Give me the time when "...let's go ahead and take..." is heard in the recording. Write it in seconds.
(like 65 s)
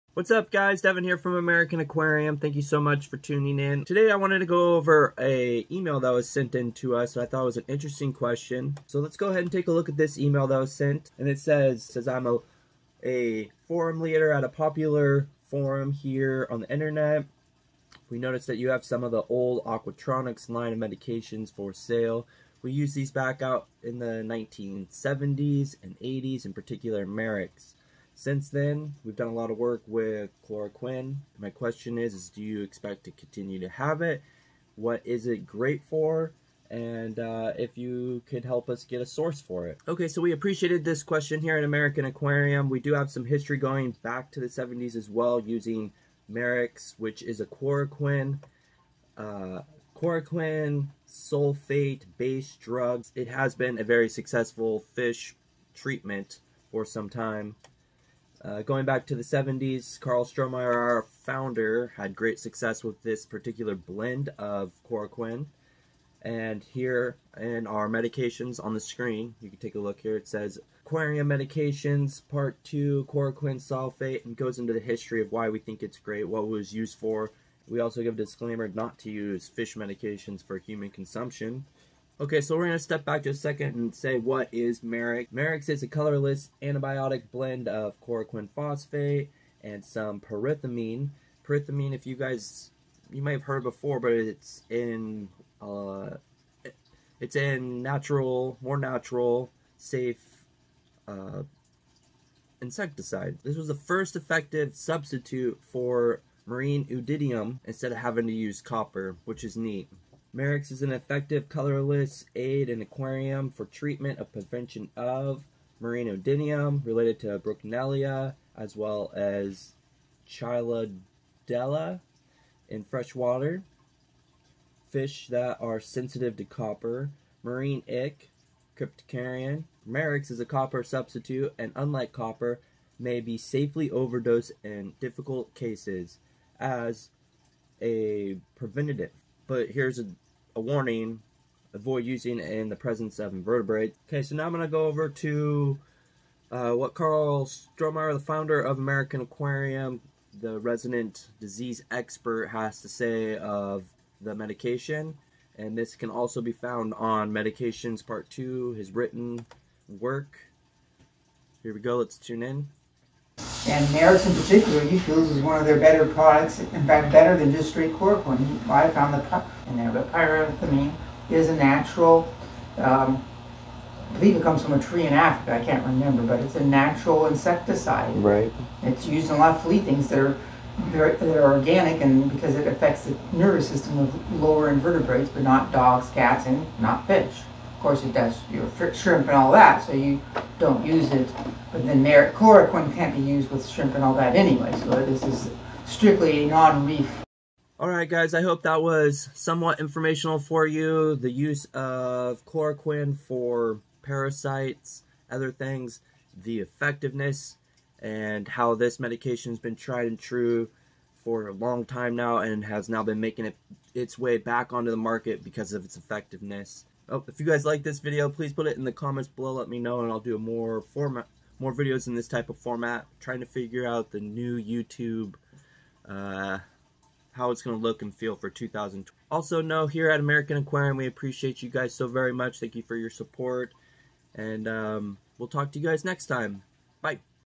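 8 s.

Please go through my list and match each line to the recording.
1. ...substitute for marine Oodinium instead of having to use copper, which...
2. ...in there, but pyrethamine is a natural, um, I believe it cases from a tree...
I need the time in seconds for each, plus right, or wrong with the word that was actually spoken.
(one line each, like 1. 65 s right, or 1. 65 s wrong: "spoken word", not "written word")
1. 104 s right
2. 169 s wrong: "comes", not "cases".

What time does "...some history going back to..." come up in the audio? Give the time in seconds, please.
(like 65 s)
43 s.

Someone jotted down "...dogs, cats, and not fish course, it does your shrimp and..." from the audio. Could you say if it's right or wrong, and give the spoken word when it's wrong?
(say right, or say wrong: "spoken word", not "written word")
right.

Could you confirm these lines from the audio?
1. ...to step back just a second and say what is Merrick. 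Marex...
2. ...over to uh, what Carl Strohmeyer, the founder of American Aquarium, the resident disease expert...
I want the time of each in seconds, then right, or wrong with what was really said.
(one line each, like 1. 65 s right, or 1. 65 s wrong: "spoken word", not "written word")
1. 82 s right
2. 144 s right.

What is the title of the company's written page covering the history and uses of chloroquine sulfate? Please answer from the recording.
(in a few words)
Aquarium Medications Part 2.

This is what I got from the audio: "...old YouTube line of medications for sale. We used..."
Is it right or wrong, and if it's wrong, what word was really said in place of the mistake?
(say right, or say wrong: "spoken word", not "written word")
wrong: "Aquatronics", not "YouTube".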